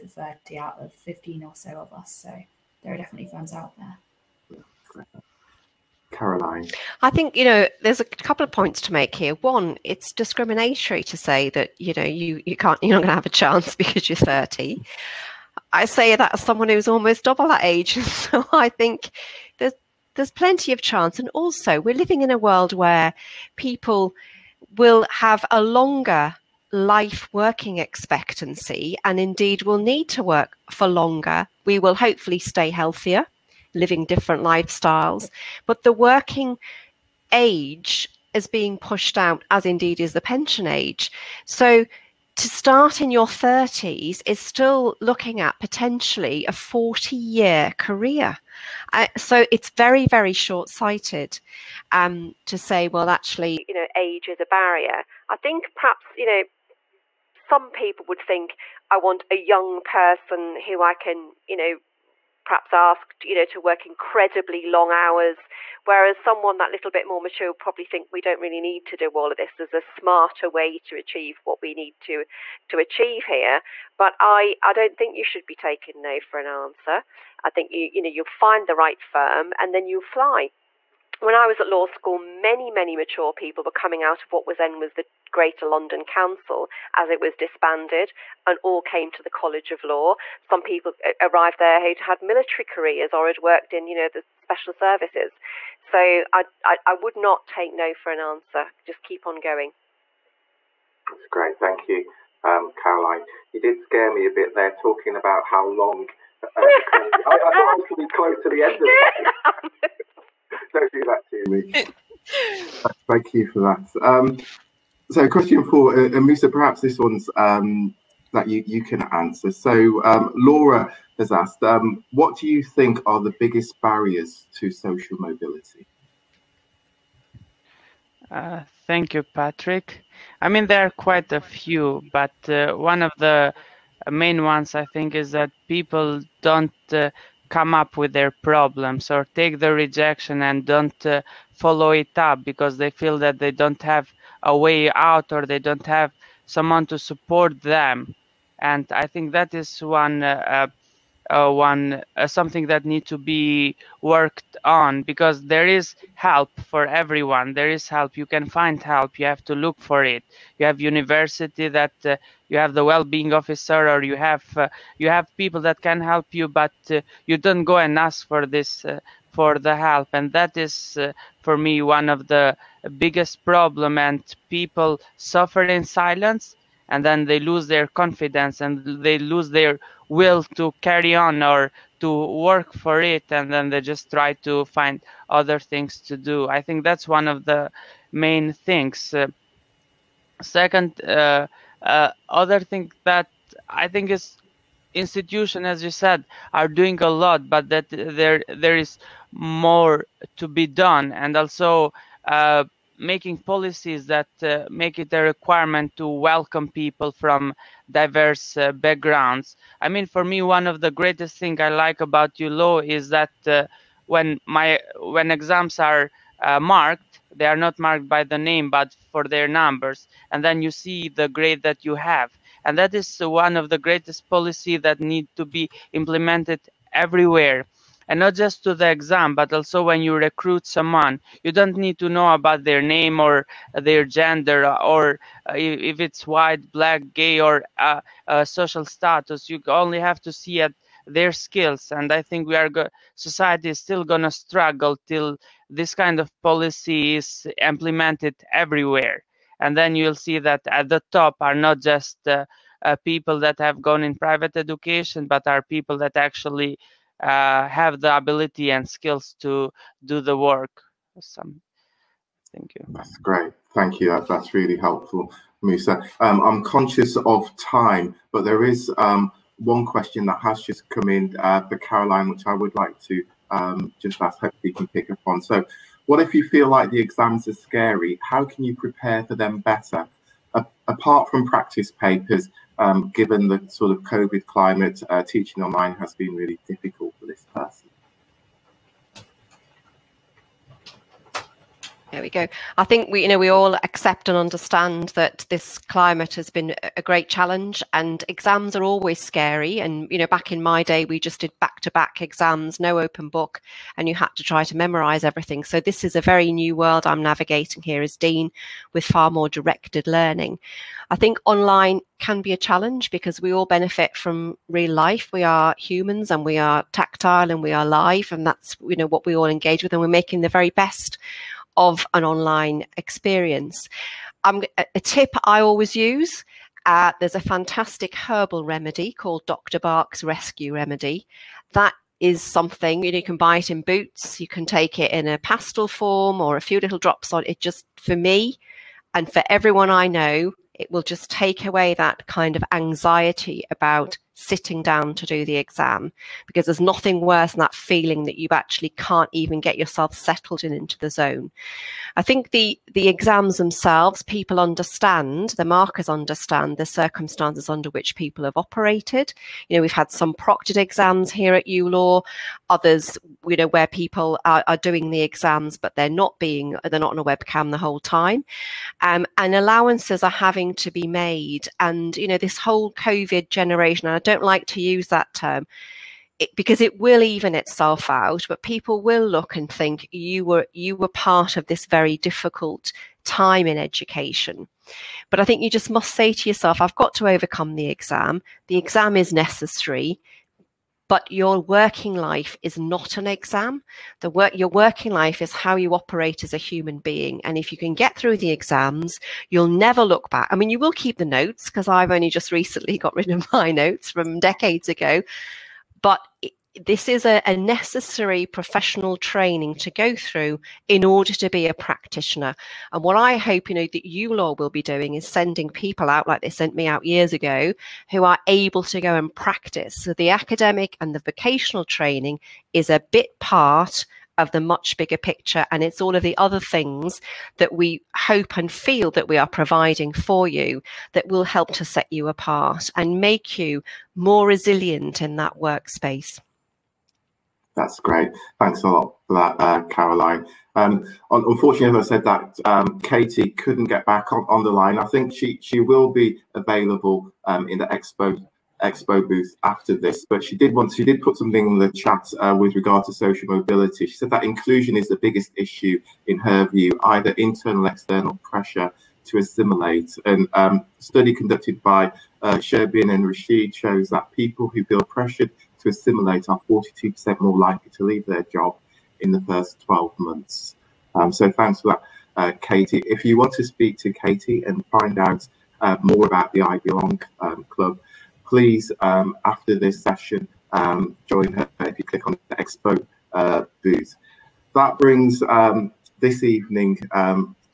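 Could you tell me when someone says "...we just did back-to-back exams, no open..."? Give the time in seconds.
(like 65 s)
301 s.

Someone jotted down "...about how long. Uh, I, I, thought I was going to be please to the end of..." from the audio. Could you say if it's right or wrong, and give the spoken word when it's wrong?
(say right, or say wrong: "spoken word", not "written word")
wrong: "close", not "please".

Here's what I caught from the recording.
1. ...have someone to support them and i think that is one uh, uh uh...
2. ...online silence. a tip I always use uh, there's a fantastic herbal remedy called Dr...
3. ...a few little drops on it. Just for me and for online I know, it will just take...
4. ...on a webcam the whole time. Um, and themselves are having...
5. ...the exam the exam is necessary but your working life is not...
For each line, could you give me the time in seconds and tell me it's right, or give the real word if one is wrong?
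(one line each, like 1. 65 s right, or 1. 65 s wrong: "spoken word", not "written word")
1. 145 s right
2. 322 s wrong: "experience", not "silence"
3. 336 s wrong: "everyone", not "online"
4. 367 s wrong: "allowances", not "themselves"
5. 387 s right.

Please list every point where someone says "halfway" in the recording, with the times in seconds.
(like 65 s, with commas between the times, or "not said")
not said.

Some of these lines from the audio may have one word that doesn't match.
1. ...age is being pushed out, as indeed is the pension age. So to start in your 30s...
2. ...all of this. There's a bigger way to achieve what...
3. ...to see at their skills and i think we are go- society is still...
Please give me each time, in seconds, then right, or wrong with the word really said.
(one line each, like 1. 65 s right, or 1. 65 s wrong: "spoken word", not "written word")
1. 37 s right
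2. 69 s wrong: "smarter", not "bigger"
3. 240 s right.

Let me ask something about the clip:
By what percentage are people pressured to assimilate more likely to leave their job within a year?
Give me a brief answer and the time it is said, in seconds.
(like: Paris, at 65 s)
42%, at 466 s.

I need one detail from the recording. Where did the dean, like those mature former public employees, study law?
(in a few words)
College of Law.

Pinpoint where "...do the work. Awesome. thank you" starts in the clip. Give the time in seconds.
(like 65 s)
260 s.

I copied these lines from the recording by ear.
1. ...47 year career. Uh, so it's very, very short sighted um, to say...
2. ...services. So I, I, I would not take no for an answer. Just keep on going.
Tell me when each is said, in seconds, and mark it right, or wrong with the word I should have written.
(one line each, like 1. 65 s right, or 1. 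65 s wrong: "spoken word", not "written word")
1. 46 s wrong: "40", not "47"
2. 94 s right.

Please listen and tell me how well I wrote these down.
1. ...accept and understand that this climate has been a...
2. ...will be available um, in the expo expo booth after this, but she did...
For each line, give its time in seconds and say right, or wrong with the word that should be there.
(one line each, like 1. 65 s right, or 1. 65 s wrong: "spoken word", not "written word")
1. 293 s right
2. 445 s right.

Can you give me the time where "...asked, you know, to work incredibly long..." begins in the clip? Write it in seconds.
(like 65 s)
62 s.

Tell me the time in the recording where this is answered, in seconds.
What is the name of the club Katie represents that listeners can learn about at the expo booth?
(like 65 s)
476 s.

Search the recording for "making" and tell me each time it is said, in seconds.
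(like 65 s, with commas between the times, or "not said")
202 s, 320 s.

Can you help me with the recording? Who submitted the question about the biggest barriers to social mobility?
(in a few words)
Laura.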